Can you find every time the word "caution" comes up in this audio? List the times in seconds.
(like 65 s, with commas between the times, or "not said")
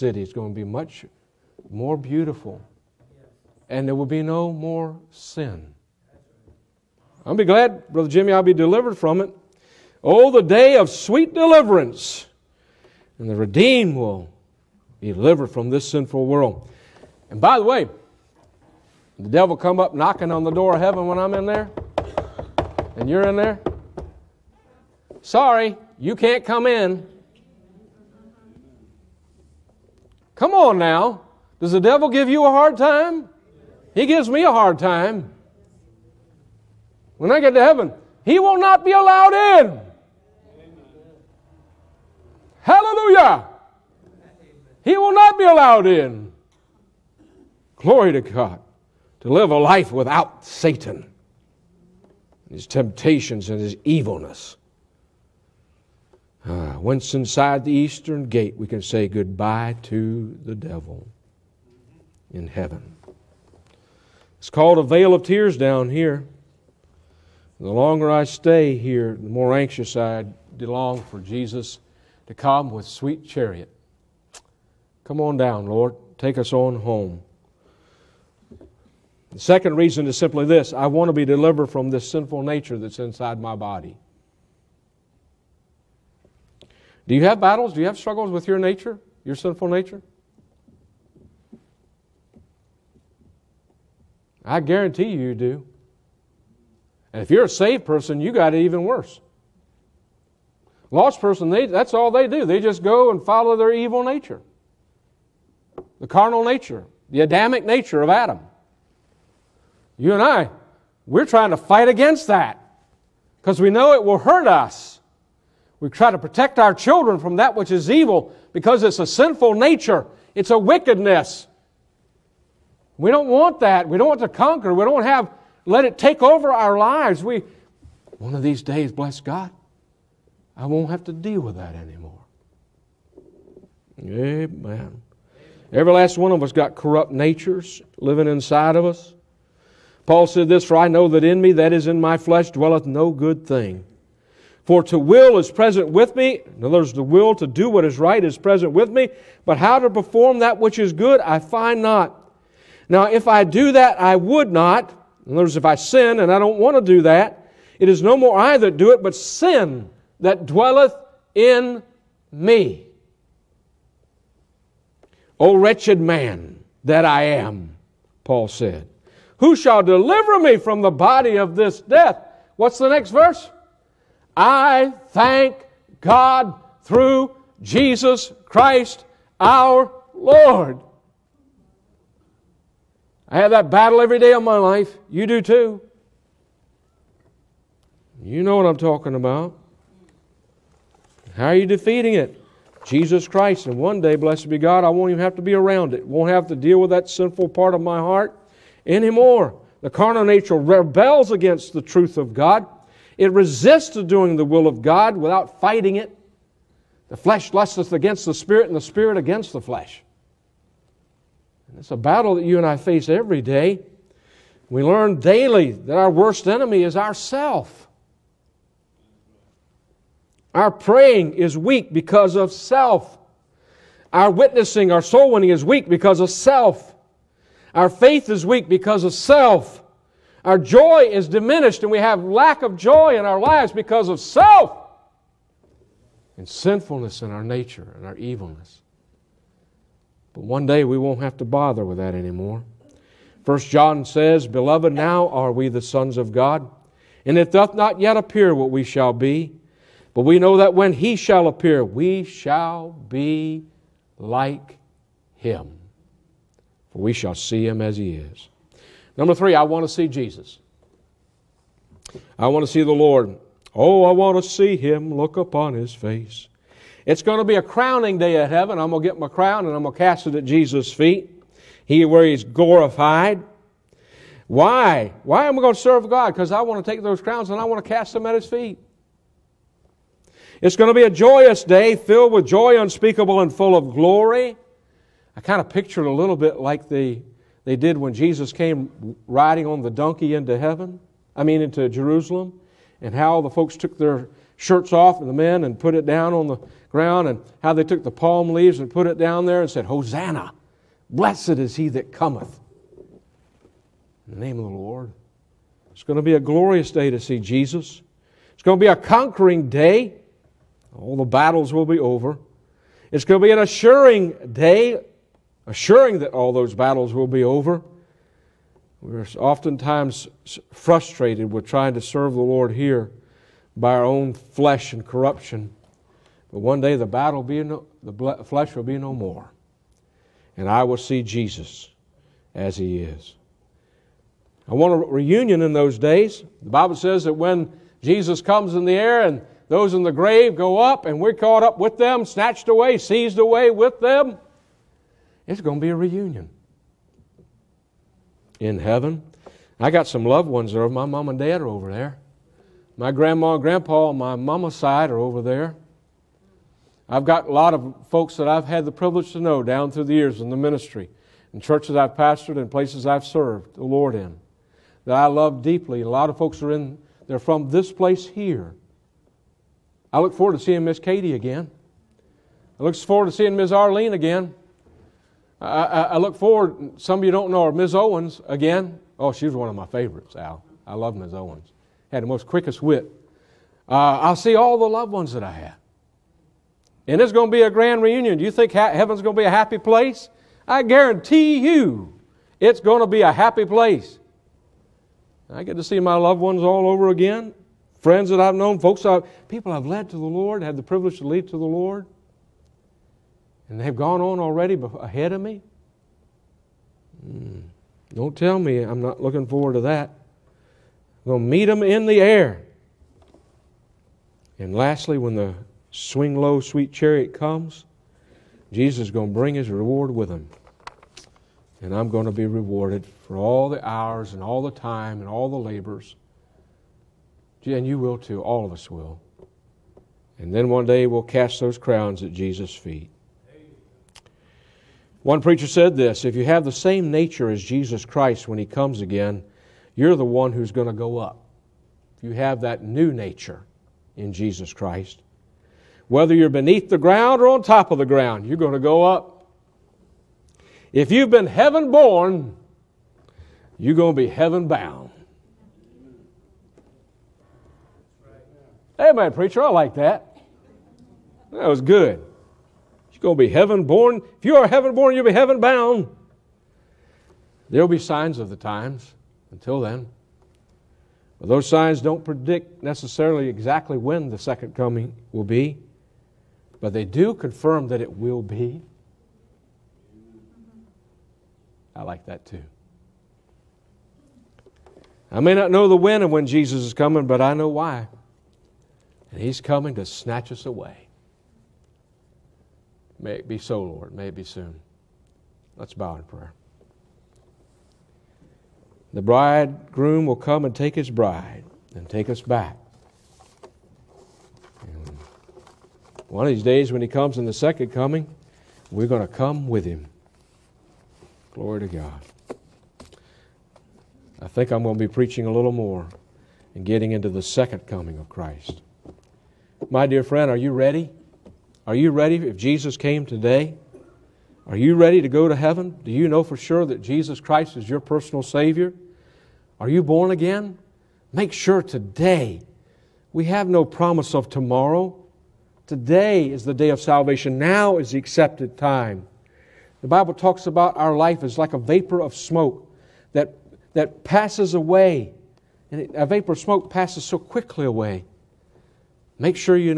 not said.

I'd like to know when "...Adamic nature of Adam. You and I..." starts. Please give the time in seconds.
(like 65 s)
107 s.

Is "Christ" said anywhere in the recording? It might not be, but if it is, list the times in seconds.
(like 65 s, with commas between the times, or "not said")
178 s, 193 s, 438 s, 444 s, 518 s, 527 s.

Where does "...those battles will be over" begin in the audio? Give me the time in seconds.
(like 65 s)
316 s.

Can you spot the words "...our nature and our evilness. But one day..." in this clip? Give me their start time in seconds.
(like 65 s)
237 s.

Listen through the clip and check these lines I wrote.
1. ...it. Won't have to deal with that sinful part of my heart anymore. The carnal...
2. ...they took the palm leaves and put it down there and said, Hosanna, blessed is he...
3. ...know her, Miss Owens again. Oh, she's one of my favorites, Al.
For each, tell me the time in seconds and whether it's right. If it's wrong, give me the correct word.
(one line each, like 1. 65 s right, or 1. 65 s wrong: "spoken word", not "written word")
1. 195 s right
2. 297 s right
3. 377 s right.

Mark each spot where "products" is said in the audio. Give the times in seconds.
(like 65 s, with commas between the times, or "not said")
not said.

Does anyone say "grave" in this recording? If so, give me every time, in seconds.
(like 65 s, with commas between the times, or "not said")
340 s.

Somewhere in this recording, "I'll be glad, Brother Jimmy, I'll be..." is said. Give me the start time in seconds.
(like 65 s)
7 s.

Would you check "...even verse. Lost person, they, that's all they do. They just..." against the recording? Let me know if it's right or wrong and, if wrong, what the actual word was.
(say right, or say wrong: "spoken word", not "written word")
wrong: "worse", not "verse".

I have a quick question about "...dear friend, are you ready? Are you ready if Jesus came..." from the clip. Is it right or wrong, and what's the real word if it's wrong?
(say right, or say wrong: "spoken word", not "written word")
right.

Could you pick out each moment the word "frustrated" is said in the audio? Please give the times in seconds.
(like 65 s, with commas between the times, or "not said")
320 s.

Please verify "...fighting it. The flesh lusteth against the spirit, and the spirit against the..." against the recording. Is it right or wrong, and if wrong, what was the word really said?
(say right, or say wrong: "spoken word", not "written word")
right.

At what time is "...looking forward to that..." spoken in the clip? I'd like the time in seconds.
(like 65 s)
409 s.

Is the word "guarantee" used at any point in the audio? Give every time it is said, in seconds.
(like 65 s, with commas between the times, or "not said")
94 s, 390 s.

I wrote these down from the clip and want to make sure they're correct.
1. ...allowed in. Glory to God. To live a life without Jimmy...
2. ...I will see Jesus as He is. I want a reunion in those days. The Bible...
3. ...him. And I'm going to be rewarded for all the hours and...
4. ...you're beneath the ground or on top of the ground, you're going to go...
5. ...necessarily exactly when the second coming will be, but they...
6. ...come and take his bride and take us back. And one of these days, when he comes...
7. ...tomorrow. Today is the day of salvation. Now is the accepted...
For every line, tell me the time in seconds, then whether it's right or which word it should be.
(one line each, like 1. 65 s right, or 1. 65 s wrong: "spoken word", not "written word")
1. 45 s wrong: "Satan", not "Jimmy"
2. 330 s right
3. 420 s right
4. 446 s right
5. 472 s right
6. 500 s right
7. 534 s right.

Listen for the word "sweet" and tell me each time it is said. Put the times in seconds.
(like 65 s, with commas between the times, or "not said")
10 s, 72 s, 416 s.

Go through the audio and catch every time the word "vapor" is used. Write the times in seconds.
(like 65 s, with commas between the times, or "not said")
541 s, 546 s.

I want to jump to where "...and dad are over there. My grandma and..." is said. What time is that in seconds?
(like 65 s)
351 s.